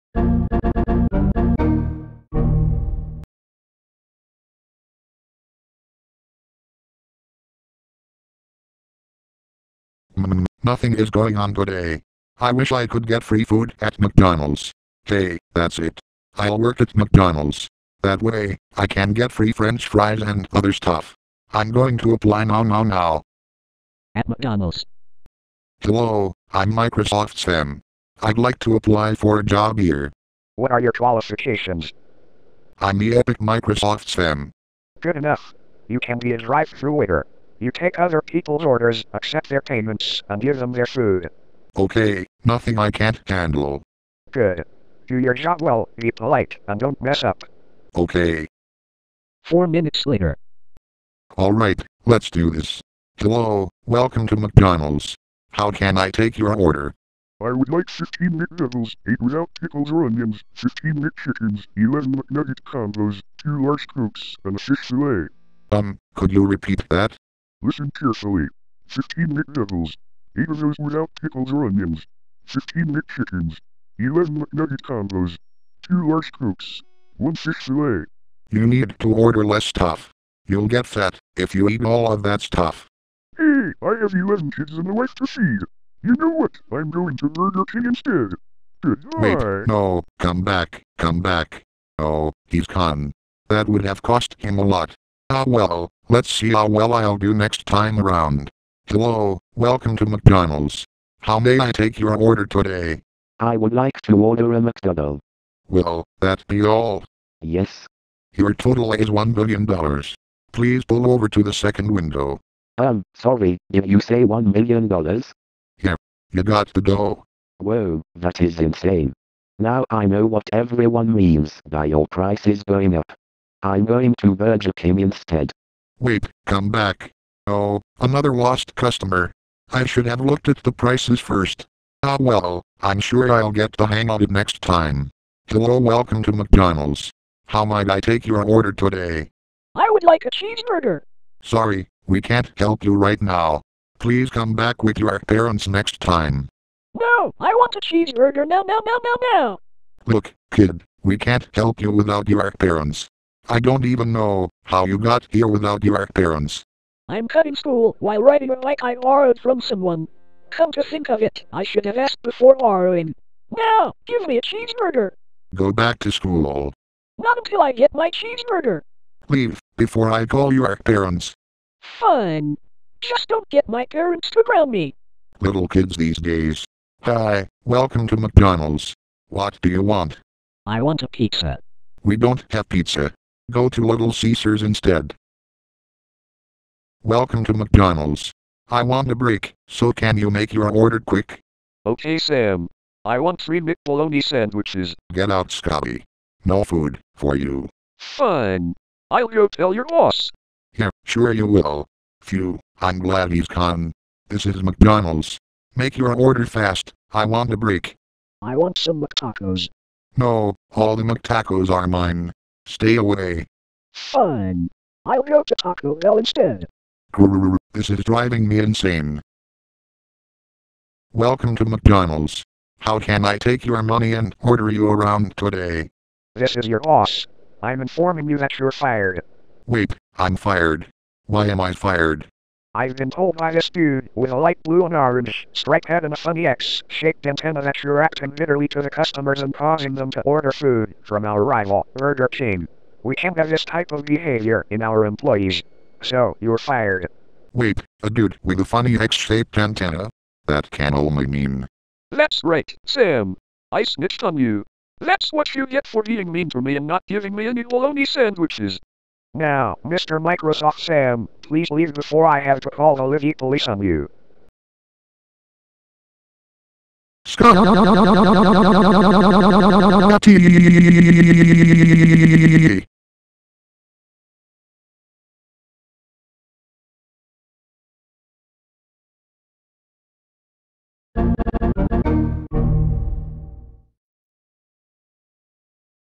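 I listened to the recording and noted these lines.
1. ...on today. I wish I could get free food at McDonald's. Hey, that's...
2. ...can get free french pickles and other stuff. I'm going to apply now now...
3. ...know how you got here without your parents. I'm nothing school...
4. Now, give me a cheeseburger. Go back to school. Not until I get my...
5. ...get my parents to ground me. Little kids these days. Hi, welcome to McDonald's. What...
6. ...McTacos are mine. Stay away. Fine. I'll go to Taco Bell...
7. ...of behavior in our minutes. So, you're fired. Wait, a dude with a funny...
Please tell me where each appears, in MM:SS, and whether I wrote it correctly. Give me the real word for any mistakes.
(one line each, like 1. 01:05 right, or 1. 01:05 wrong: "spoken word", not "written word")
1. 00:11 right
2. 00:18 wrong: "fries", not "pickles"
3. 02:34 wrong: "cutting", not "nothing"
4. 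02:43 right
5. 02:53 right
6. 03:31 right
7. 04:03 wrong: "employees", not "minutes".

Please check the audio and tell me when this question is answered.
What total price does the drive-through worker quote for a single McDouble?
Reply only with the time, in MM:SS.
01:49.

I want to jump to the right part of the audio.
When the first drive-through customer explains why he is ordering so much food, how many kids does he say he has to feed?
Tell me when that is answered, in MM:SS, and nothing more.
01:24.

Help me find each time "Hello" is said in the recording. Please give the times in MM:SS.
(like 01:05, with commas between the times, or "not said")
00:25, 00:53, 01:38, 02:15.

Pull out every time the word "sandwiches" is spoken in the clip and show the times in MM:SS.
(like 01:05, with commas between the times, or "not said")
03:14, 04:18.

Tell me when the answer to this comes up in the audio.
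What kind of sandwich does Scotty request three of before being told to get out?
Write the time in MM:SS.
03:13.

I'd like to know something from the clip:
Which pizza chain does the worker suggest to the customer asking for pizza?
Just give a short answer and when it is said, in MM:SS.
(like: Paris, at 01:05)
Little Caesars, at 03:03.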